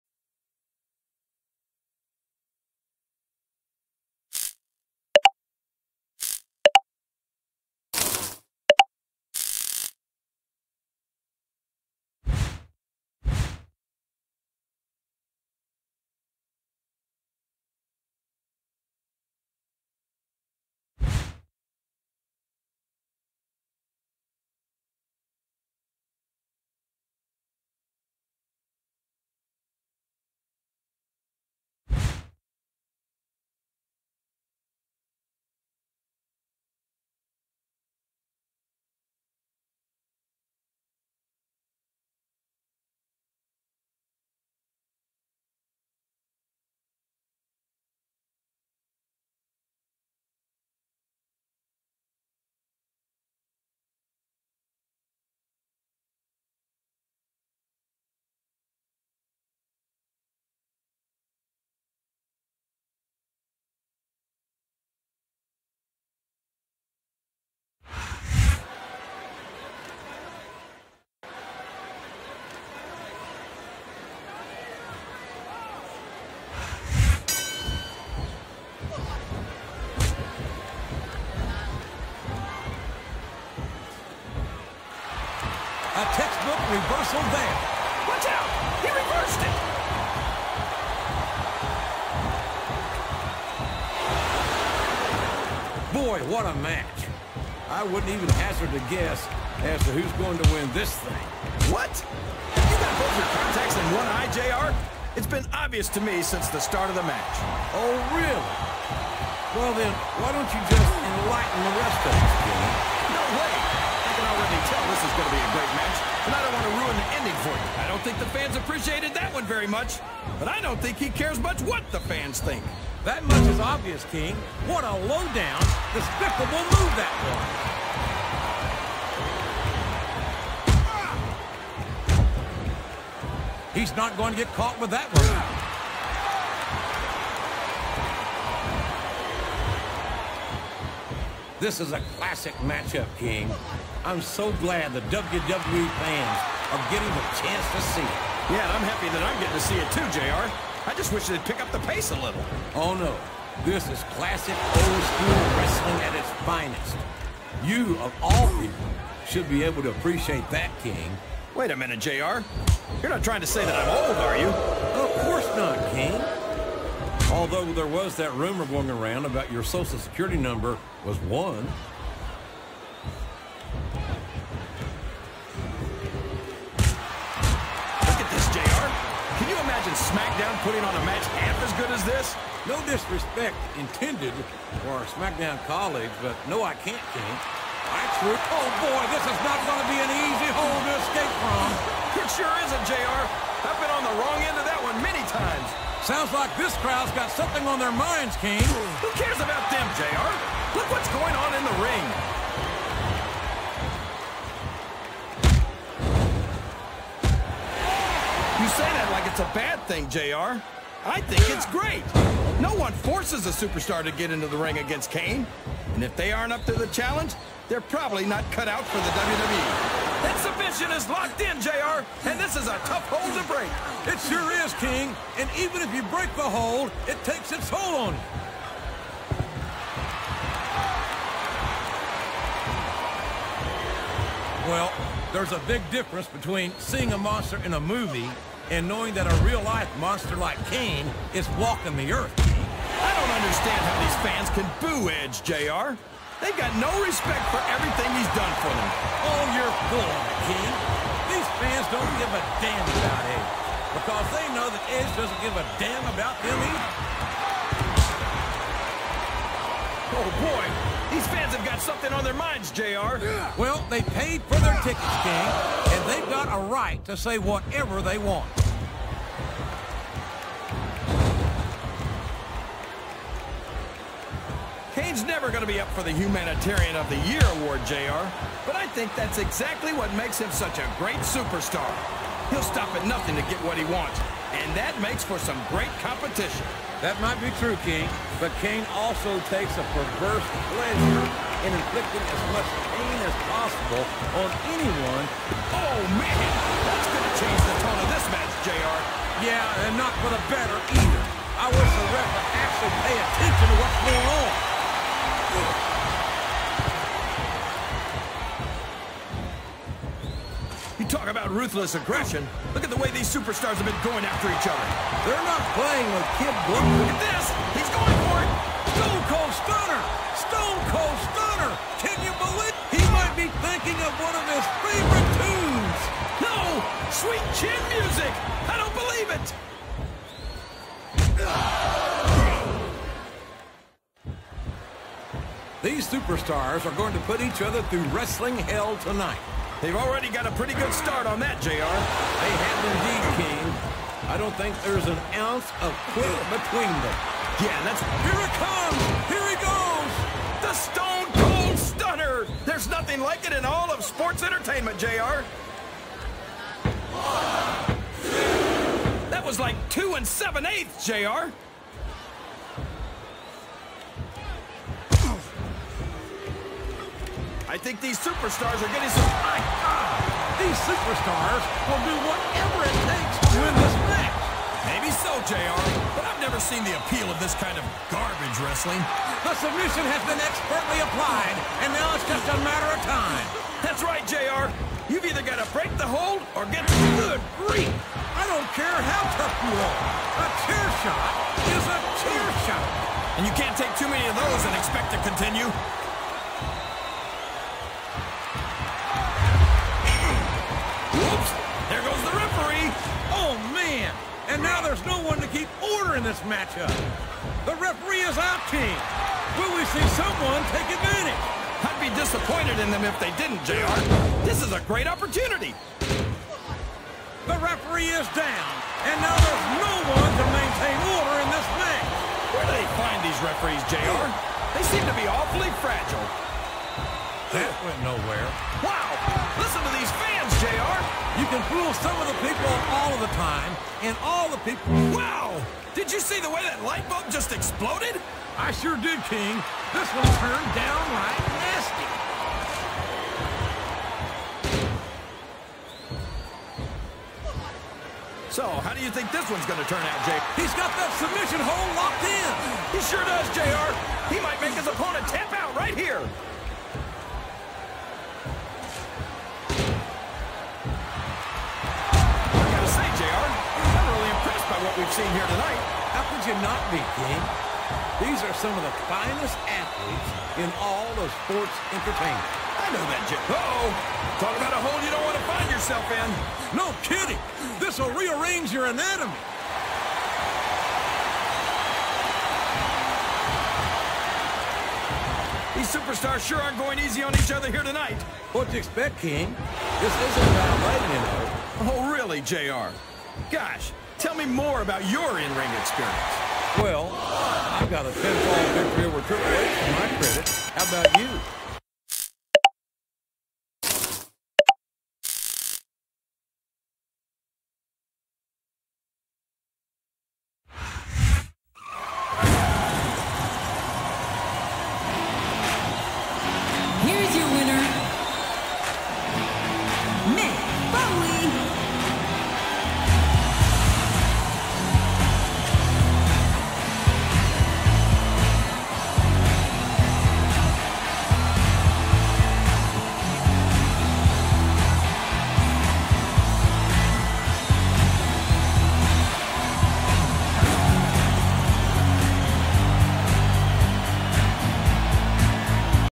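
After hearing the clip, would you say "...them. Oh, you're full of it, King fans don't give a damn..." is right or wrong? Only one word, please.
right.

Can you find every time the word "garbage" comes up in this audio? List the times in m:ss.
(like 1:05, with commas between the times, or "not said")
6:18.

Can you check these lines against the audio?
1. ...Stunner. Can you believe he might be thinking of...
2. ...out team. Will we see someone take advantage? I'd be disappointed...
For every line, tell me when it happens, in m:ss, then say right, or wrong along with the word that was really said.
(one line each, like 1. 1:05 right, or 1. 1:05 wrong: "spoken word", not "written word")
1. 5:21 right
2. 6:48 right.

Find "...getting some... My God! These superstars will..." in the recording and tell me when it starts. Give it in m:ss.
6:08.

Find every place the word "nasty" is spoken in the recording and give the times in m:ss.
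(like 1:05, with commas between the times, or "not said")
7:21.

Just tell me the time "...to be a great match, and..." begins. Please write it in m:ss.
1:55.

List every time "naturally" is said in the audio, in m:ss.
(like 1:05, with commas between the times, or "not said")
not said.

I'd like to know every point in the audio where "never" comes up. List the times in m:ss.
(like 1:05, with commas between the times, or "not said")
4:35, 6:16.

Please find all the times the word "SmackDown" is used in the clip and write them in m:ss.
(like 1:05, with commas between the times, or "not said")
3:00, 3:05.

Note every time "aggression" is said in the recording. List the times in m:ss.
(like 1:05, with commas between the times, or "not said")
5:11.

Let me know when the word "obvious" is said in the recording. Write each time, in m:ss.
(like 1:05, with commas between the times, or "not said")
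1:45, 2:03.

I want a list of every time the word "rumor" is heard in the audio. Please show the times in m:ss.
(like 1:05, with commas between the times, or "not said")
2:48.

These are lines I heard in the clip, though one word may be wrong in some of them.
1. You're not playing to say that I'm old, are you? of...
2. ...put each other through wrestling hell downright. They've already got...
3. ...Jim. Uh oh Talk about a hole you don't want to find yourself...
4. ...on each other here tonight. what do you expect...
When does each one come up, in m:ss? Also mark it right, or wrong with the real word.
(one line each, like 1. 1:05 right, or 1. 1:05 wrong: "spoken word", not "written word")
1. 2:43 wrong: "trying", not "playing"
2. 5:37 wrong: "tonight", not "downright"
3. 7:53 right
4. 8:07 right.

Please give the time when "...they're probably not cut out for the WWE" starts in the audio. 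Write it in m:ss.
3:37.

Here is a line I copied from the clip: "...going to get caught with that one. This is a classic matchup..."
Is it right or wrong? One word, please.
right.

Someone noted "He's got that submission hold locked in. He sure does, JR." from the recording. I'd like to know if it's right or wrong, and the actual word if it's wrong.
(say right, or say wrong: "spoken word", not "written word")
right.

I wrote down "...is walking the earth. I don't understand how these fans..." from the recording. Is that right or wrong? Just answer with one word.
right.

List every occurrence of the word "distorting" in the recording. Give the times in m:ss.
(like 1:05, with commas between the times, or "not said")
not said.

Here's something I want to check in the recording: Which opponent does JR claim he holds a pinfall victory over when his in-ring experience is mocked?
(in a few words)
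Triple H.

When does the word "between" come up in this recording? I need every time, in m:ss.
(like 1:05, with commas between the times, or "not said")
3:56, 5:46.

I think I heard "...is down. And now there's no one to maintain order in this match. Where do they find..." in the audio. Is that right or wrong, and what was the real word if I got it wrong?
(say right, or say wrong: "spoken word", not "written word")
right.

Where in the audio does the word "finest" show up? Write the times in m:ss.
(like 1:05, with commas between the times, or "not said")
2:36, 7:49.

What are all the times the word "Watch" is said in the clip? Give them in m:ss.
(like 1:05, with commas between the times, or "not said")
1:28.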